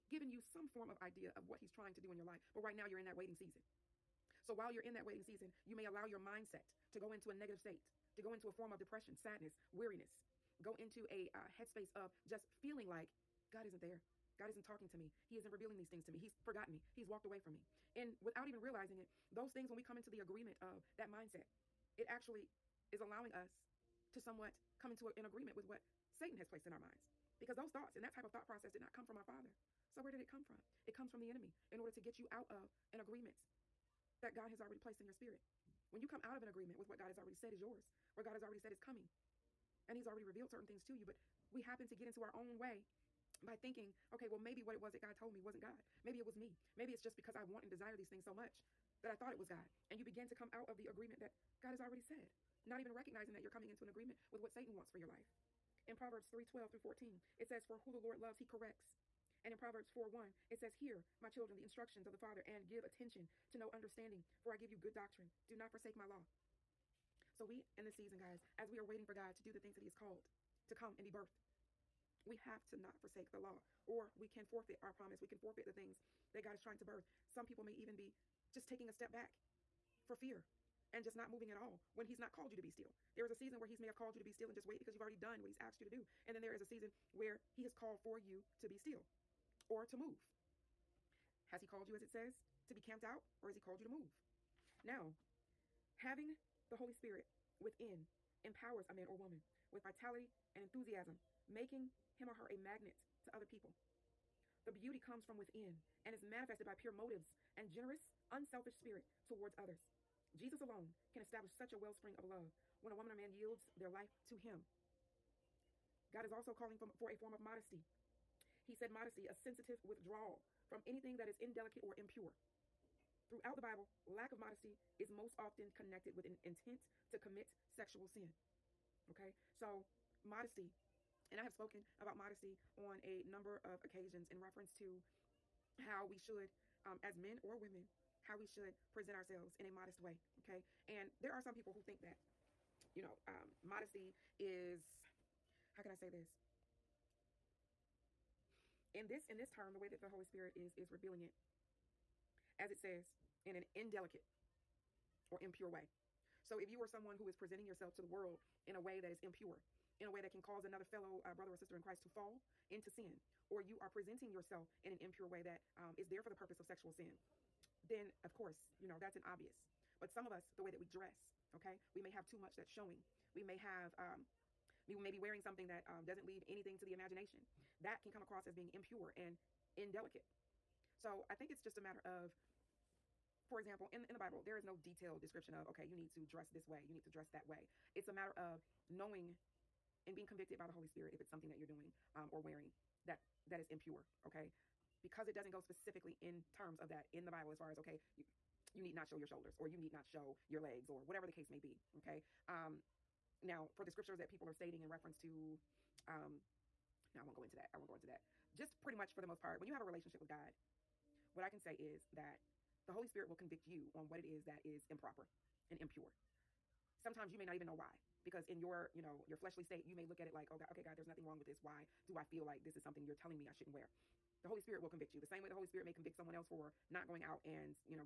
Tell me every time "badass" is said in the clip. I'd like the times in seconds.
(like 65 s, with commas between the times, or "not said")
not said.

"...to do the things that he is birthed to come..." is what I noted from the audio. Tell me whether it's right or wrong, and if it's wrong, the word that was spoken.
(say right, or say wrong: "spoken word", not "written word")
wrong: "called", not "birthed".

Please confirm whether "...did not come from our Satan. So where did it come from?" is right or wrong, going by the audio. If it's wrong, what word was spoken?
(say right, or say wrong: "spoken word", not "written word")
wrong: "Father", not "Satan".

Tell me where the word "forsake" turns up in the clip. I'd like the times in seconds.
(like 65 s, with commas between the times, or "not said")
65 s, 73 s.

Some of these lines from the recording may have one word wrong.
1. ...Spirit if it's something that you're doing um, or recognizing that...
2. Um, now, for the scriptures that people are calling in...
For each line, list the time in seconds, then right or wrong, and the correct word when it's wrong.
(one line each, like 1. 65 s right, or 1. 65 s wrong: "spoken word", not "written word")
1. 190 s wrong: "wearing", not "recognizing"
2. 202 s wrong: "stating", not "calling".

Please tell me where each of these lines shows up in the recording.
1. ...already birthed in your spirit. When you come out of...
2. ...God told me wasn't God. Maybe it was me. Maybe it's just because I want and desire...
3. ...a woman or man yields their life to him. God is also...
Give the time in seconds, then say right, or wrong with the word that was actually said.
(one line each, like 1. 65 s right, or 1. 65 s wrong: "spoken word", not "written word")
1. 34 s wrong: "placed", not "birthed"
2. 45 s right
3. 112 s right.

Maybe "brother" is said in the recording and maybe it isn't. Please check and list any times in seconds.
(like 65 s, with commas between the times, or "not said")
161 s.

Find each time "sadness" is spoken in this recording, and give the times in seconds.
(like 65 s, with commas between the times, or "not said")
9 s.